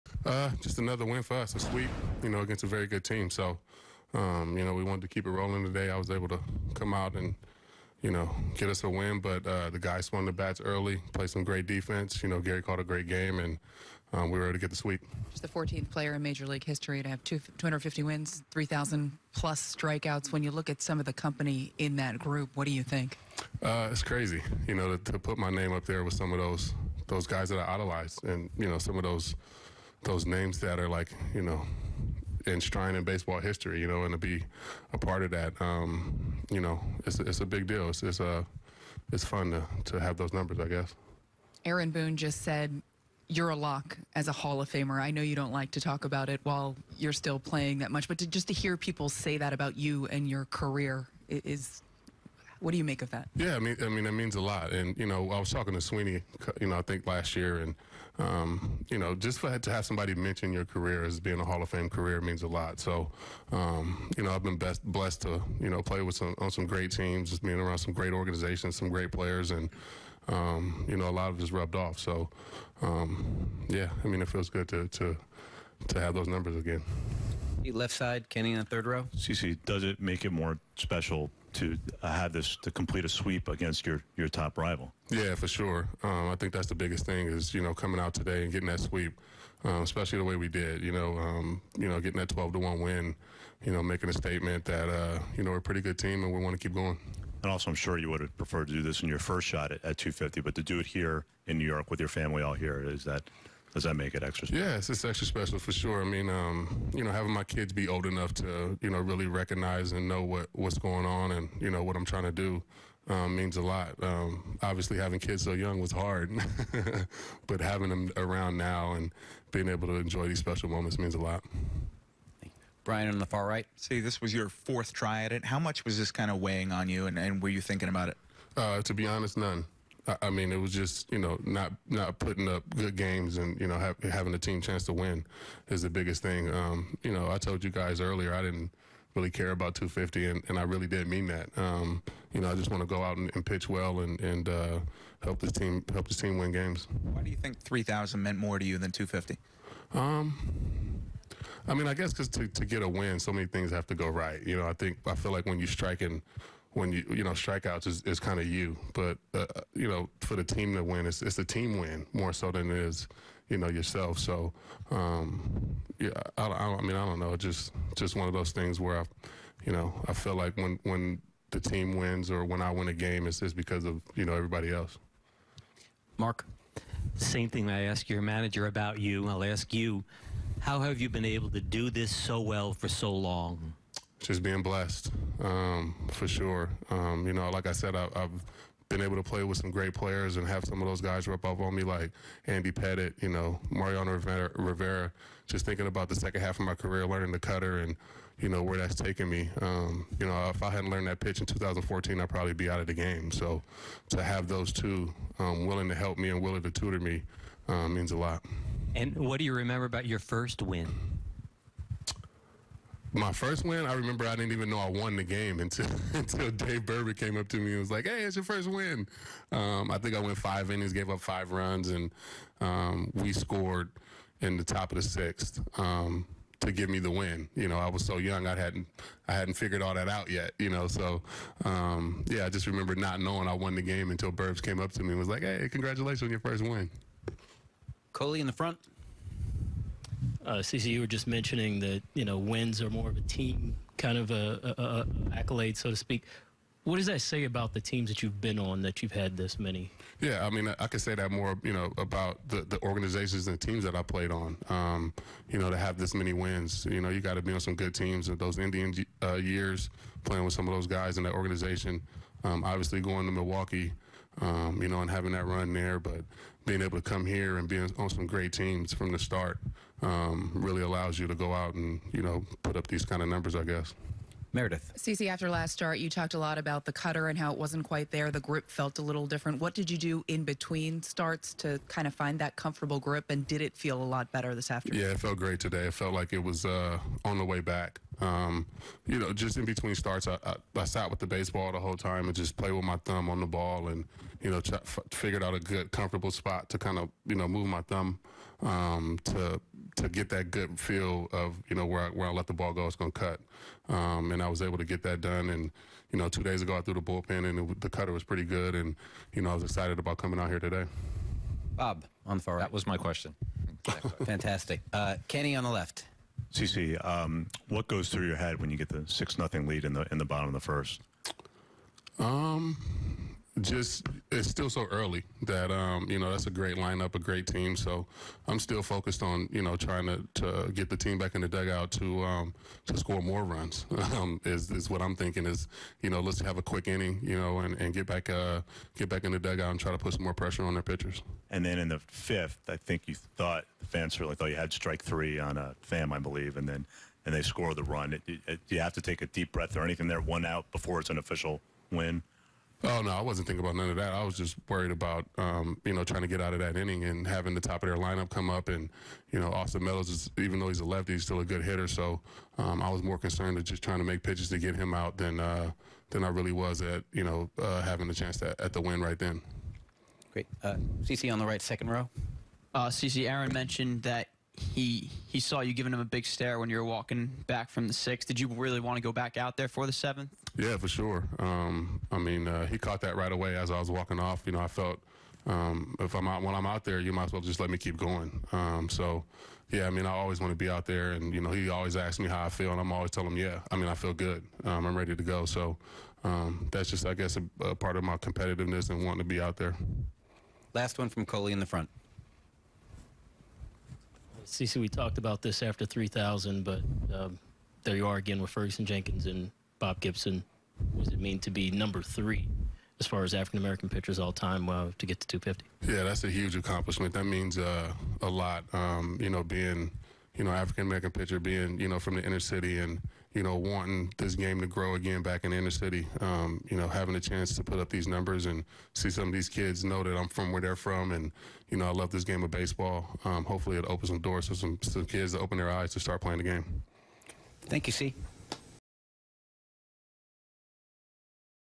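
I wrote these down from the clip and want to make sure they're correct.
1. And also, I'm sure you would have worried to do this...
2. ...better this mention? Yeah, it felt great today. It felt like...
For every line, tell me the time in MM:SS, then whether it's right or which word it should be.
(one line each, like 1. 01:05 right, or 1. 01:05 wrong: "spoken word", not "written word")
1. 01:37 wrong: "preferred", not "worried"
2. 04:44 wrong: "afternoon", not "mention".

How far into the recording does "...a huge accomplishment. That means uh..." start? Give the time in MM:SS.
06:56.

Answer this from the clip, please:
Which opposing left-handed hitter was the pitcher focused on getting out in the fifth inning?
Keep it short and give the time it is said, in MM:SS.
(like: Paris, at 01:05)
Austin Meadows, at 05:59.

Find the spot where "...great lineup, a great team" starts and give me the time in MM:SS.
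05:26.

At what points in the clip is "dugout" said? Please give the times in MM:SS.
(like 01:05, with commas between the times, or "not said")
05:31, 05:39.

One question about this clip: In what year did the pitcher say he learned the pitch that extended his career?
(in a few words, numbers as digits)
2014.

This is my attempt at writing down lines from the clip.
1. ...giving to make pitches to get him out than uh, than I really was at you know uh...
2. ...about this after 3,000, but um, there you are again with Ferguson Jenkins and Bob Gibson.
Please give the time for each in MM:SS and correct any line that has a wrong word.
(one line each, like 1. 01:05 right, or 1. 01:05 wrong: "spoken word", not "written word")
1. 06:03 wrong: "trying", not "giving"
2. 06:45 right.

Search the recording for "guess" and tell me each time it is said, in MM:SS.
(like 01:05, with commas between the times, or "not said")
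00:40, 02:31, 04:33, 06:37.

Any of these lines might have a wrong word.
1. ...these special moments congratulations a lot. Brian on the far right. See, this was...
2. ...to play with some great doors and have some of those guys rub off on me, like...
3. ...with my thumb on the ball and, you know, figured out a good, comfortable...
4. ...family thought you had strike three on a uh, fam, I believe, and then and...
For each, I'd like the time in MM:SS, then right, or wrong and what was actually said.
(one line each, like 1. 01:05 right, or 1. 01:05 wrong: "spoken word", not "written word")
1. 02:00 wrong: "means", not "congratulations"
2. 03:09 wrong: "players", not "doors"
3. 04:52 right
4. 05:44 wrong: "certainly", not "family".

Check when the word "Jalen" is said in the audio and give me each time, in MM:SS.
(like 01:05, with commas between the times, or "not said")
not said.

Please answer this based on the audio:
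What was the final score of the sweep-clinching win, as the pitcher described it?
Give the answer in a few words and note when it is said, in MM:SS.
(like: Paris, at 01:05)
12 to 1, at 01:32.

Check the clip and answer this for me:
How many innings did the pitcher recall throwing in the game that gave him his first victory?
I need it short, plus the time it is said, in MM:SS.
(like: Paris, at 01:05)
5, at 03:40.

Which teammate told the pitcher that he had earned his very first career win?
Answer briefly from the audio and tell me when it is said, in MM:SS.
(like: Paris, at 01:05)
Dave Burba, at 03:36.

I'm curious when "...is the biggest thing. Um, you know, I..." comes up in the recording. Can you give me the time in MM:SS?
02:15.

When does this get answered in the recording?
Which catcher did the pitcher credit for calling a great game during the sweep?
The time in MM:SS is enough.
00:12.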